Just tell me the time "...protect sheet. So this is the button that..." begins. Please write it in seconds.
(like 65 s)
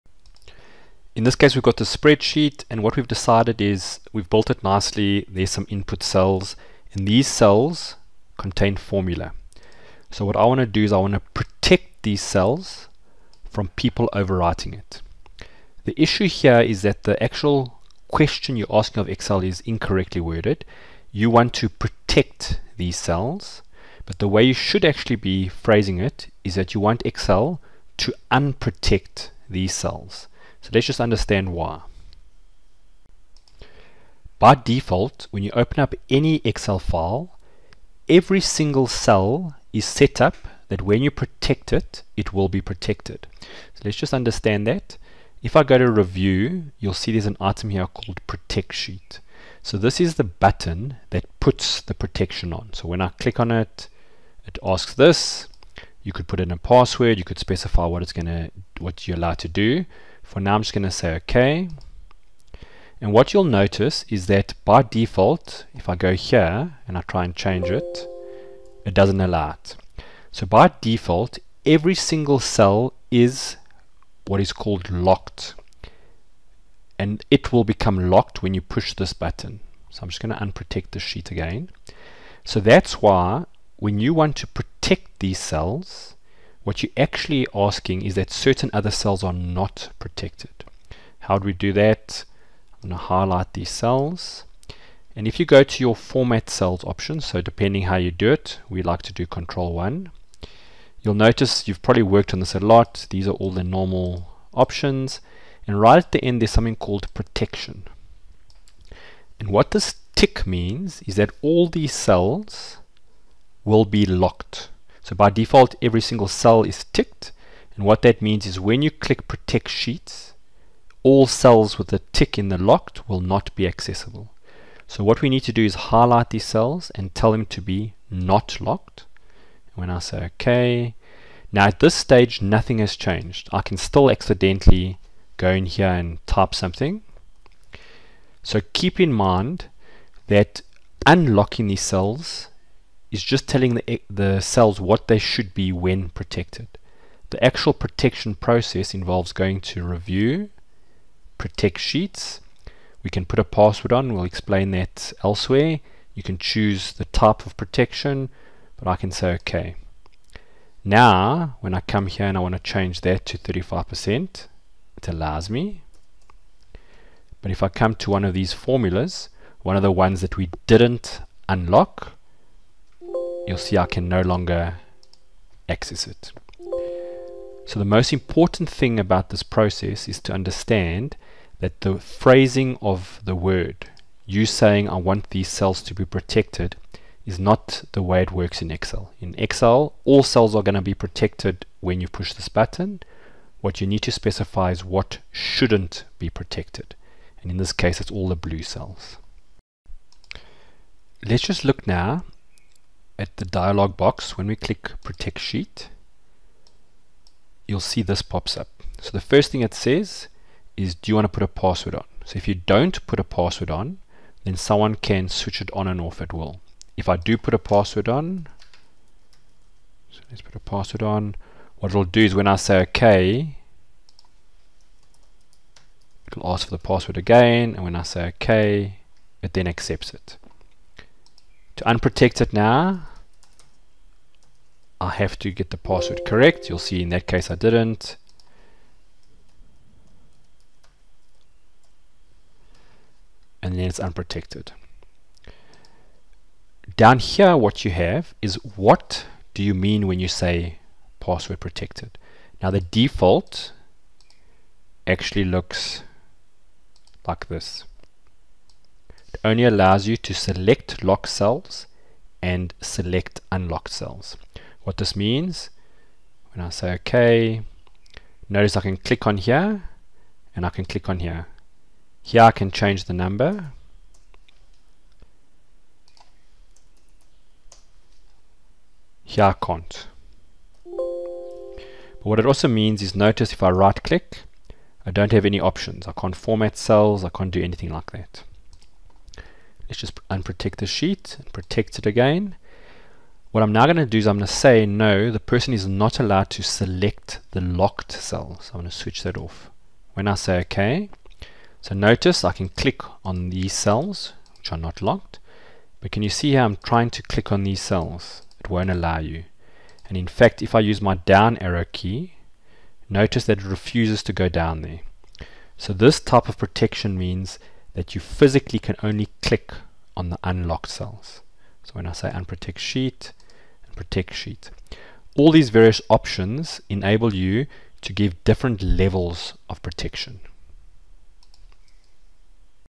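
48 s.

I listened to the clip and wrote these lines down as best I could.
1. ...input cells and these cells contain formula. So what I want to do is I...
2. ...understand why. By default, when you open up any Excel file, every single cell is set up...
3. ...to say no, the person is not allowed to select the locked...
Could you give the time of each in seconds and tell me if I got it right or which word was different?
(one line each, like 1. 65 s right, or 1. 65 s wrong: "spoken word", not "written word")
1. 5 s right
2. 31 s right
3. 294 s right.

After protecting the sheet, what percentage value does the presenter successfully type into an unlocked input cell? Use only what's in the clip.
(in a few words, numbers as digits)
35%.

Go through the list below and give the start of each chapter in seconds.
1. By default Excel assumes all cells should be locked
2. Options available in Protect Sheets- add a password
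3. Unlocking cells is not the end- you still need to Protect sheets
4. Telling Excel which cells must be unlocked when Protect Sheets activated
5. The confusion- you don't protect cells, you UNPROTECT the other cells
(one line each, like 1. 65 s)
1. 30 s
2. 204 s
3. 130 s
4. 90 s
5. 15 s.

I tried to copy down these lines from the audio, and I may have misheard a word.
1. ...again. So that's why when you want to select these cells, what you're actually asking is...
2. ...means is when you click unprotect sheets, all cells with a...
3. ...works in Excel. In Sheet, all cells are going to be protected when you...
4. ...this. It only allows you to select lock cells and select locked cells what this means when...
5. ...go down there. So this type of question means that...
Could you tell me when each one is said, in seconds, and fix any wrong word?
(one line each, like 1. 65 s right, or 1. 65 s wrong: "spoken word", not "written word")
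1. 81 s wrong: "protect", not "select"
2. 118 s wrong: "protect", not "unprotect"
3. 188 s wrong: "Excel", not "Sheet"
4. 257 s wrong: "unlocked", not "locked"
5. 314 s wrong: "protection", not "question".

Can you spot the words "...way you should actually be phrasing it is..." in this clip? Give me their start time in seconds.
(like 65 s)
24 s.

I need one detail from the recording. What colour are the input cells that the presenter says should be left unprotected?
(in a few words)
Blue.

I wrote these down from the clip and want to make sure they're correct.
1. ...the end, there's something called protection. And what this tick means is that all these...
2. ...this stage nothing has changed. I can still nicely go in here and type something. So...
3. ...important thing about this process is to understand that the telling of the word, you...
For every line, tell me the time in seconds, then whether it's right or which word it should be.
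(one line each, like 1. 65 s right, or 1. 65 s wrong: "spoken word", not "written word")
1. 106 s right
2. 131 s wrong: "accidentally", not "nicely"
3. 178 s wrong: "phrasing", not "telling".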